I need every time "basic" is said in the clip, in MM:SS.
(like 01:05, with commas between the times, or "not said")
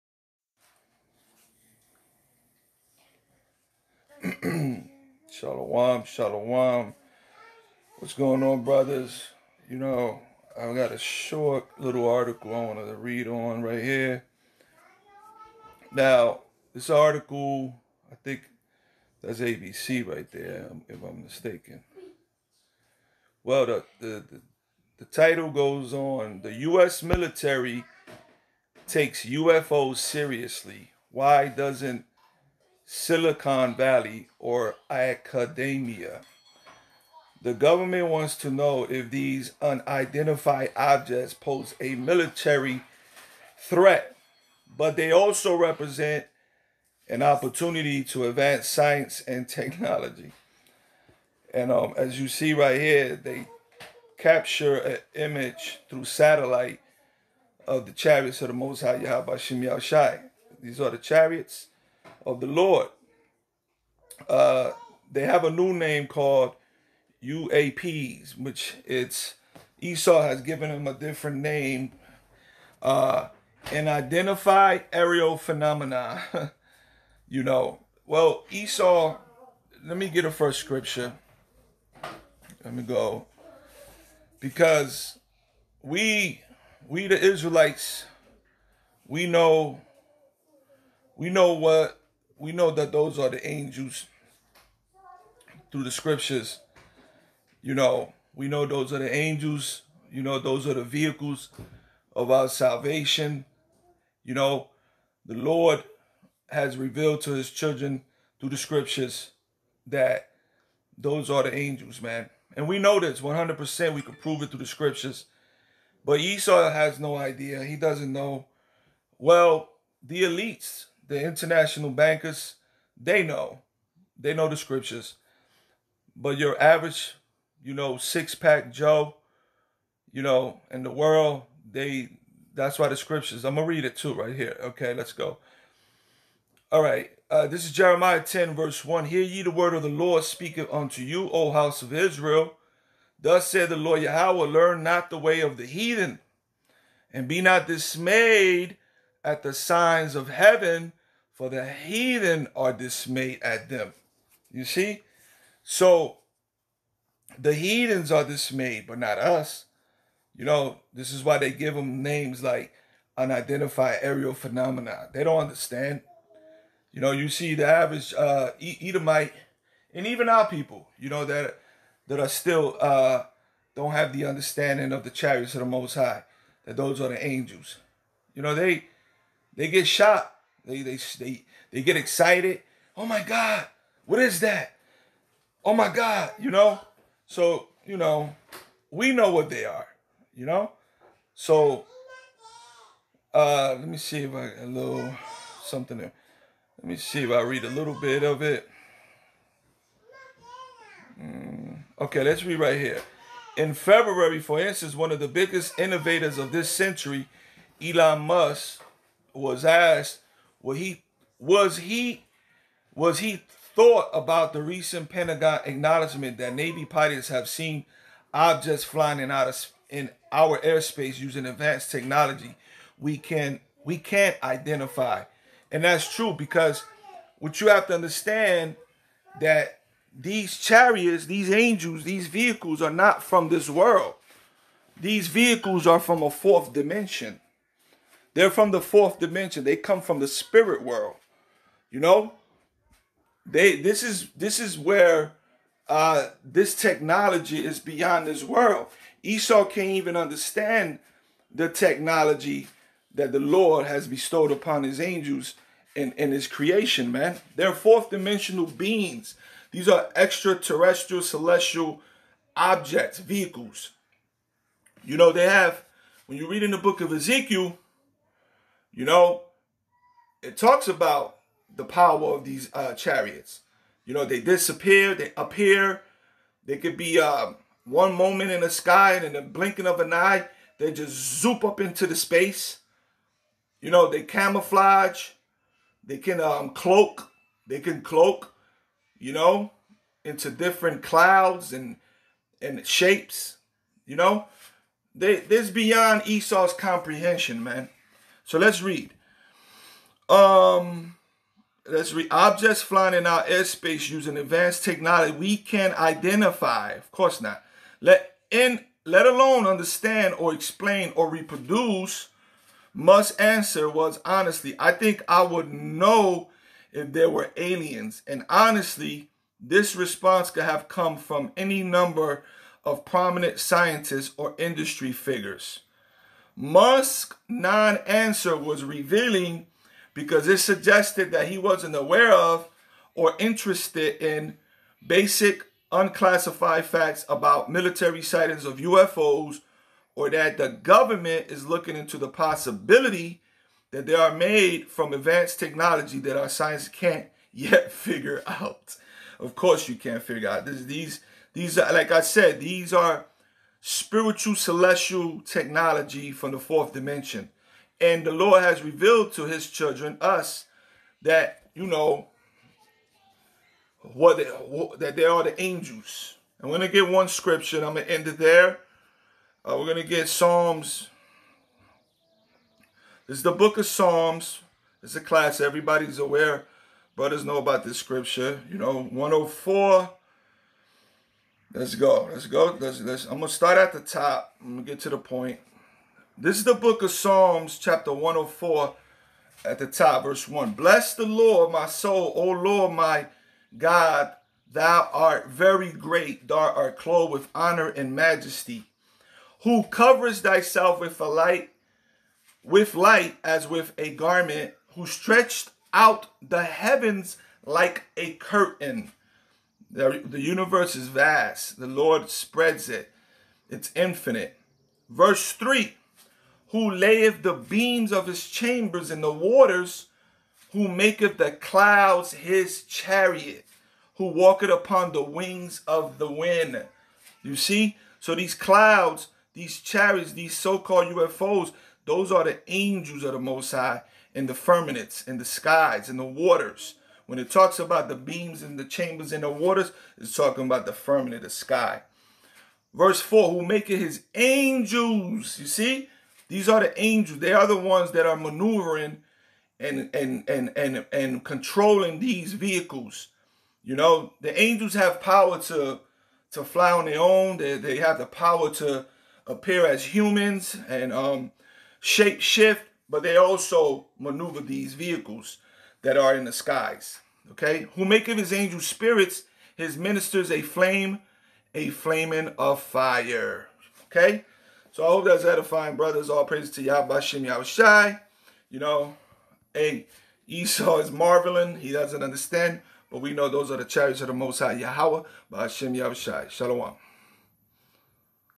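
05:35.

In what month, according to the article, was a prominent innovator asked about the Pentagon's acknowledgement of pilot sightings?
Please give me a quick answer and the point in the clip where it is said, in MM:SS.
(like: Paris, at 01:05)
February, at 03:23.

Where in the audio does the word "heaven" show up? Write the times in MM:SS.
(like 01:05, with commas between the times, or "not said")
02:30, 06:46.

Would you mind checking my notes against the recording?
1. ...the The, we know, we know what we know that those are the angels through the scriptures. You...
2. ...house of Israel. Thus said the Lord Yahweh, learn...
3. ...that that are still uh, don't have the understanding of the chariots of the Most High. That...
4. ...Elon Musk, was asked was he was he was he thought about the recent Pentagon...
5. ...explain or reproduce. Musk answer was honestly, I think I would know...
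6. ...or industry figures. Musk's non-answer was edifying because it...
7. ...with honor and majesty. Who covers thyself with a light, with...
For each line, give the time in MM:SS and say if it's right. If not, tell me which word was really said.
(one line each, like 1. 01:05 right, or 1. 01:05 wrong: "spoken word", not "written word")
1. 01:27 wrong: "Israelites", not "The"
2. 02:21 right
3. 02:51 right
4. 03:27 right
5. 05:10 right
6. 05:24 wrong: "revealing", not "edifying"
7. 06:37 right.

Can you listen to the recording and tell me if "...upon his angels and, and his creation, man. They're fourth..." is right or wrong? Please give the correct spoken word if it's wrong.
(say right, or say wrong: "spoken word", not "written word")
right.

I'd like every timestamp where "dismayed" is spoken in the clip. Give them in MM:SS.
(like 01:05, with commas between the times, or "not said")
02:27, 02:32, 02:38.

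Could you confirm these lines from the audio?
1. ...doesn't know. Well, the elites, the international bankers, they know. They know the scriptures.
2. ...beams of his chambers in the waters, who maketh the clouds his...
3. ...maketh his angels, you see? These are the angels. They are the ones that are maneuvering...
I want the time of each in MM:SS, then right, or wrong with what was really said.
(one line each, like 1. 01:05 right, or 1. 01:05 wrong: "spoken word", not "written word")
1. 01:57 right
2. 06:57 right
3. 07:23 right.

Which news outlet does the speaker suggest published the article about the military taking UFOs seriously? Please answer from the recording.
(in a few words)
ABC.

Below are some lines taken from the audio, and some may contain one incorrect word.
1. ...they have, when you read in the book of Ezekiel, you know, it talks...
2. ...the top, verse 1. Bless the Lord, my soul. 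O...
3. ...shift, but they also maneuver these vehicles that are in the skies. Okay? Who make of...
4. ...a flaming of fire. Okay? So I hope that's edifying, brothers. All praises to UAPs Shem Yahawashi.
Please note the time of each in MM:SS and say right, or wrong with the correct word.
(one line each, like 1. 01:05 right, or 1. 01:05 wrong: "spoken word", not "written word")
1. 04:25 right
2. 06:29 right
3. 07:42 right
4. 07:51 wrong: "Yahweh", not "UAPs".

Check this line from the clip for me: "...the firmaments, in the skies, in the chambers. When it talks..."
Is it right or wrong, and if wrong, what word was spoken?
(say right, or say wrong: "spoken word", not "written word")
wrong: "waters", not "chambers".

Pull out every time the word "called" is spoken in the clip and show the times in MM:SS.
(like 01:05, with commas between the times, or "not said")
01:06, 07:10.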